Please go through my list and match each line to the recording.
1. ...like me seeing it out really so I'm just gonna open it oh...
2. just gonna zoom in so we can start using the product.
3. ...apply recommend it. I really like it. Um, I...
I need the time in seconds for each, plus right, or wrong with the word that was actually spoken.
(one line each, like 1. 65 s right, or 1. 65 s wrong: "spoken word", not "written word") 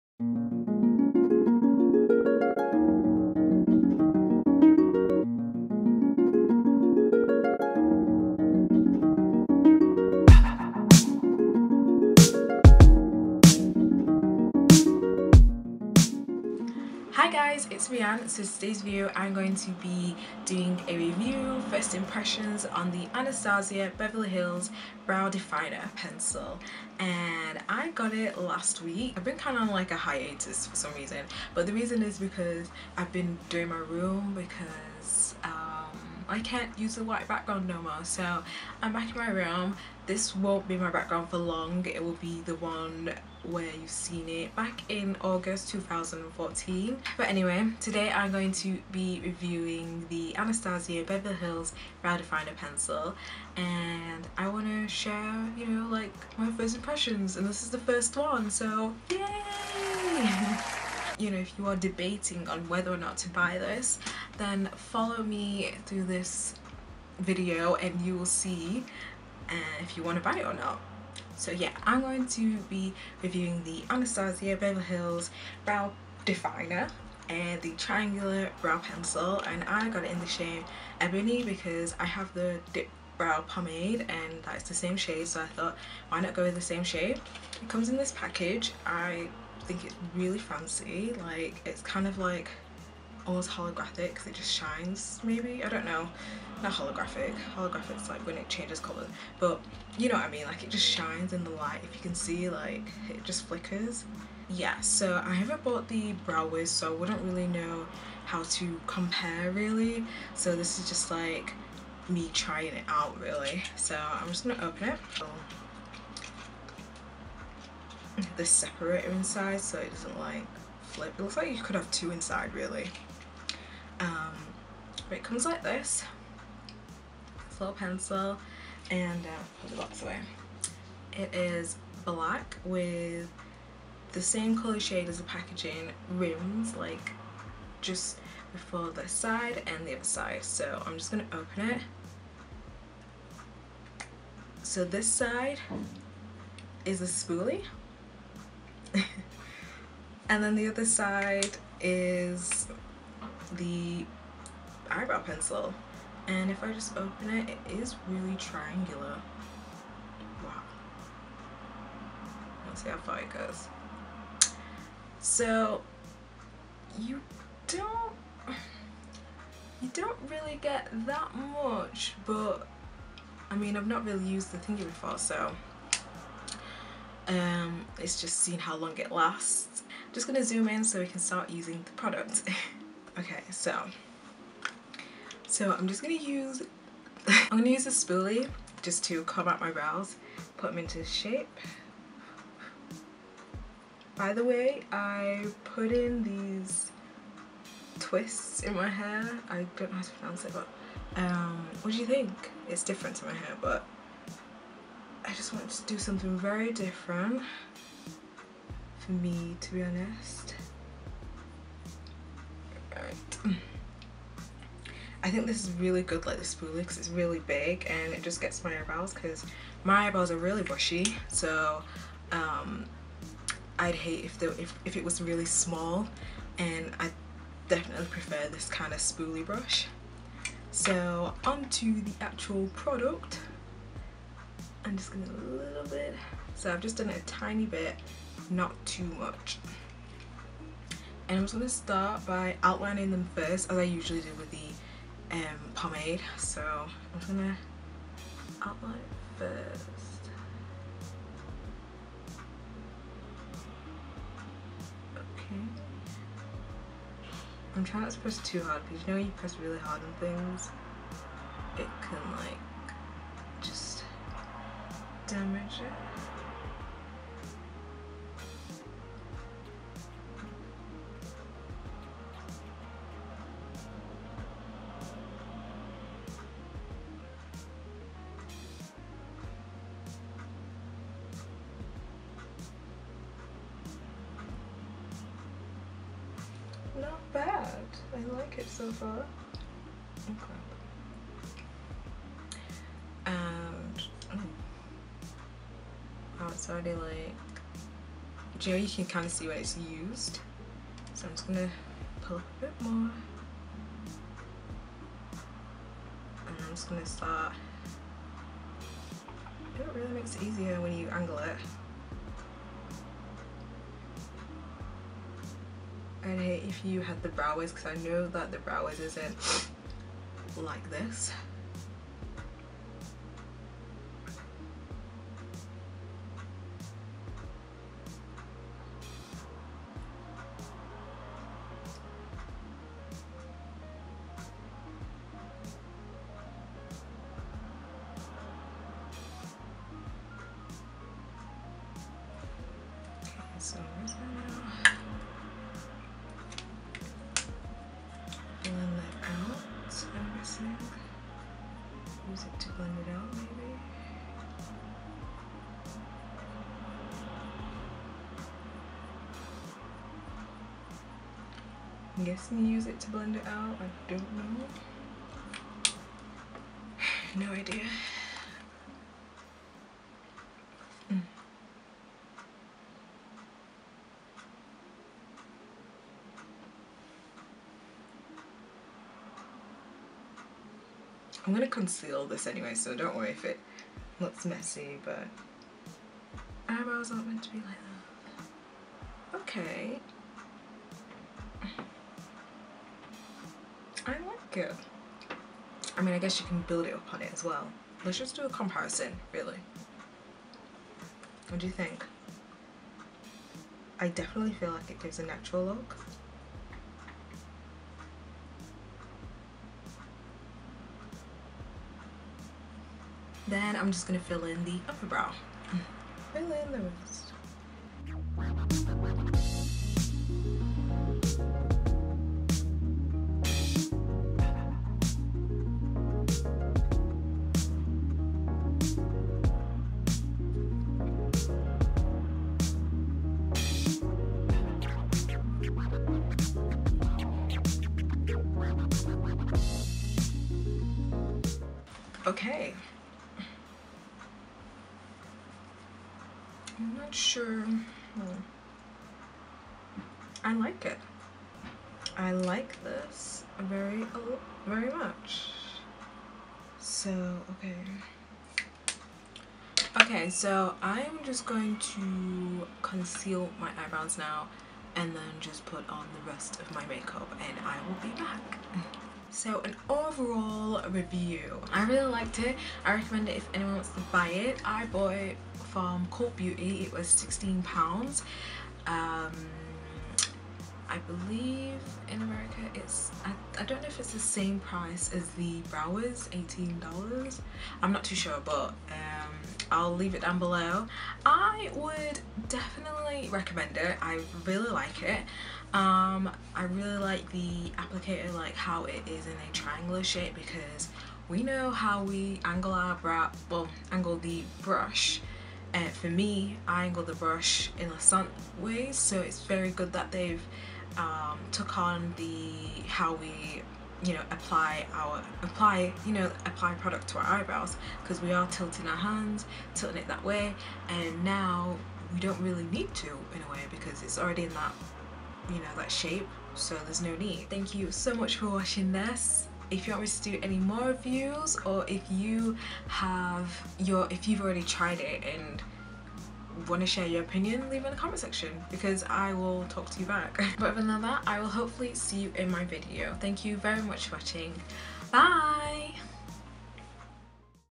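1. 111 s wrong: "trying", not "seeing"
2. 180 s right
3. 492 s wrong: "definitely", not "apply".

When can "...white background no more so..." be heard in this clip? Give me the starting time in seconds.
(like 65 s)
37 s.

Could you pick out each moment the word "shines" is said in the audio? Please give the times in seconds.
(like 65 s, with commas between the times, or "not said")
94 s, 100 s.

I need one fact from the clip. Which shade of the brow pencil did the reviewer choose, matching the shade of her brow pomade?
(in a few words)
Ebony.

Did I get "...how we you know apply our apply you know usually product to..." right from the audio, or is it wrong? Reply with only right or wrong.
wrong.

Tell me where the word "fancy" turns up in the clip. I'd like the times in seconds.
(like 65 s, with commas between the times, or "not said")
90 s.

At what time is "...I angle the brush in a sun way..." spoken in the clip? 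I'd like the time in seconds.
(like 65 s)
506 s.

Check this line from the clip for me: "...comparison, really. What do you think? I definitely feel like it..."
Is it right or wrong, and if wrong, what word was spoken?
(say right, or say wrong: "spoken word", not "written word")
right.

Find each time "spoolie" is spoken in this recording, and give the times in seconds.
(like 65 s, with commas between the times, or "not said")
147 s, 187 s, 216 s, 228 s.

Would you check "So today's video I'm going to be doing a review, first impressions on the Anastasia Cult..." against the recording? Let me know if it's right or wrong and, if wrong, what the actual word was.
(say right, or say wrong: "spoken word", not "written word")
wrong: "Beverly", not "Cult".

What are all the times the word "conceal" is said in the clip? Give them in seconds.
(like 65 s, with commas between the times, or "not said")
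381 s, 462 s.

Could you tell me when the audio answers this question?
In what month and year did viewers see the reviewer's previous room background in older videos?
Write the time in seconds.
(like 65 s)
45 s.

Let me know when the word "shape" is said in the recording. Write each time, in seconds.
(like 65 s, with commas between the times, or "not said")
191 s, 500 s, 525 s.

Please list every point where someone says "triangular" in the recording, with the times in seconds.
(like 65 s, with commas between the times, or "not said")
77 s, 158 s, 499 s.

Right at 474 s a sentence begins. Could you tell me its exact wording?
I bought it from Cult Beauty.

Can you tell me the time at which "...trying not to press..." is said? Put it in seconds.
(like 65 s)
257 s.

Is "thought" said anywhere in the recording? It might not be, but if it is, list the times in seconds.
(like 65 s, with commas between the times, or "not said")
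85 s.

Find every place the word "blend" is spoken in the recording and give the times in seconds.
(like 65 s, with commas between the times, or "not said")
352 s, 363 s.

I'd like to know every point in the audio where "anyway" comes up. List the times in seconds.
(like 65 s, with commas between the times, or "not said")
47 s, 382 s.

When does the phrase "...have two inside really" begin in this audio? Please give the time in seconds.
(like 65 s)
121 s.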